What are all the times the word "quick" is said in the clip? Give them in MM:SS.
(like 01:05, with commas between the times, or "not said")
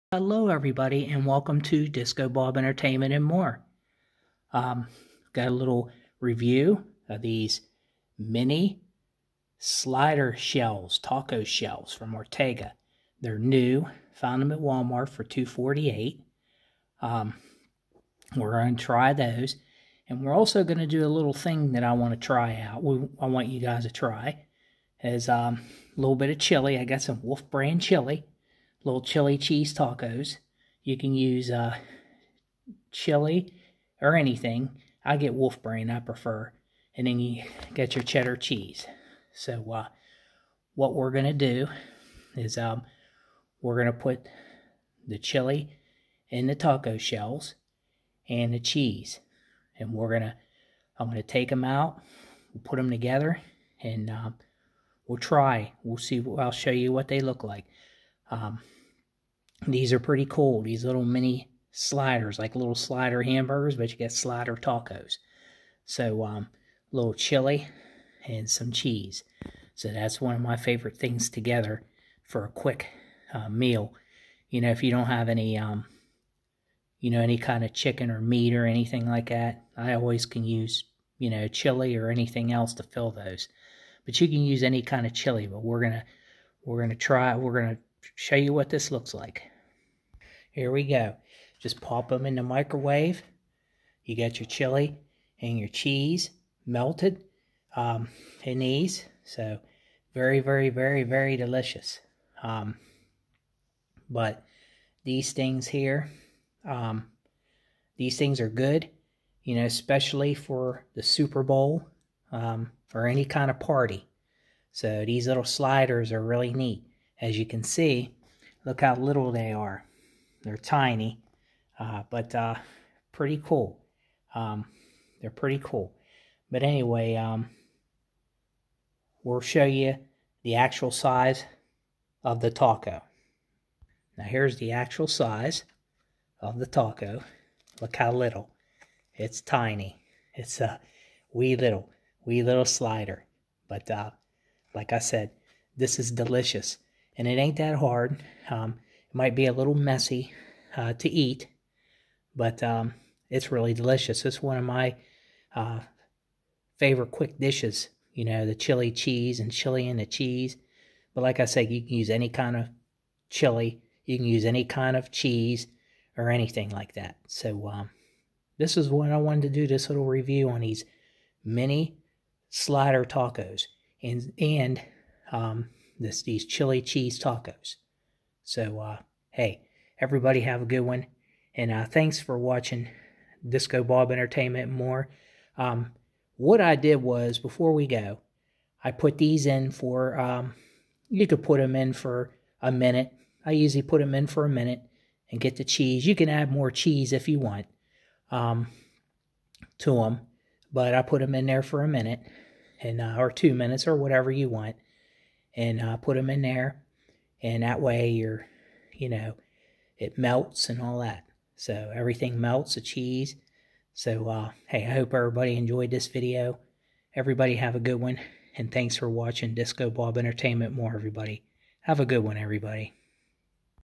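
01:12, 02:37.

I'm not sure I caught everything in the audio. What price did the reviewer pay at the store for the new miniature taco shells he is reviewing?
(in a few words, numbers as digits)
$2.48.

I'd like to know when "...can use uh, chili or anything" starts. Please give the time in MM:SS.
00:30.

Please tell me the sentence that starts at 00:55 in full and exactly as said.
We'll see, I'll show you what they look like.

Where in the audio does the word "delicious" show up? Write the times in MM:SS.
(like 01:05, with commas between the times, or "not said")
01:41, 02:26, 02:33.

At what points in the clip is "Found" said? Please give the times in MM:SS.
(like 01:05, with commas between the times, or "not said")
00:14.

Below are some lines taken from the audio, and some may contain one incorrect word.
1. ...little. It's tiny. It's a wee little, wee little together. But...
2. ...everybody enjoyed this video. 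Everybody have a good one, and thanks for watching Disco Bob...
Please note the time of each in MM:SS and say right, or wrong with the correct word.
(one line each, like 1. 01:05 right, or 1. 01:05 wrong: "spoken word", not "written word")
1. 02:18 wrong: "slider", not "together"
2. 03:35 right.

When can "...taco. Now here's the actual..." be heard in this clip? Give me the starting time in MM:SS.
02:12.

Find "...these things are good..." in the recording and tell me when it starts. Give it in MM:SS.
01:47.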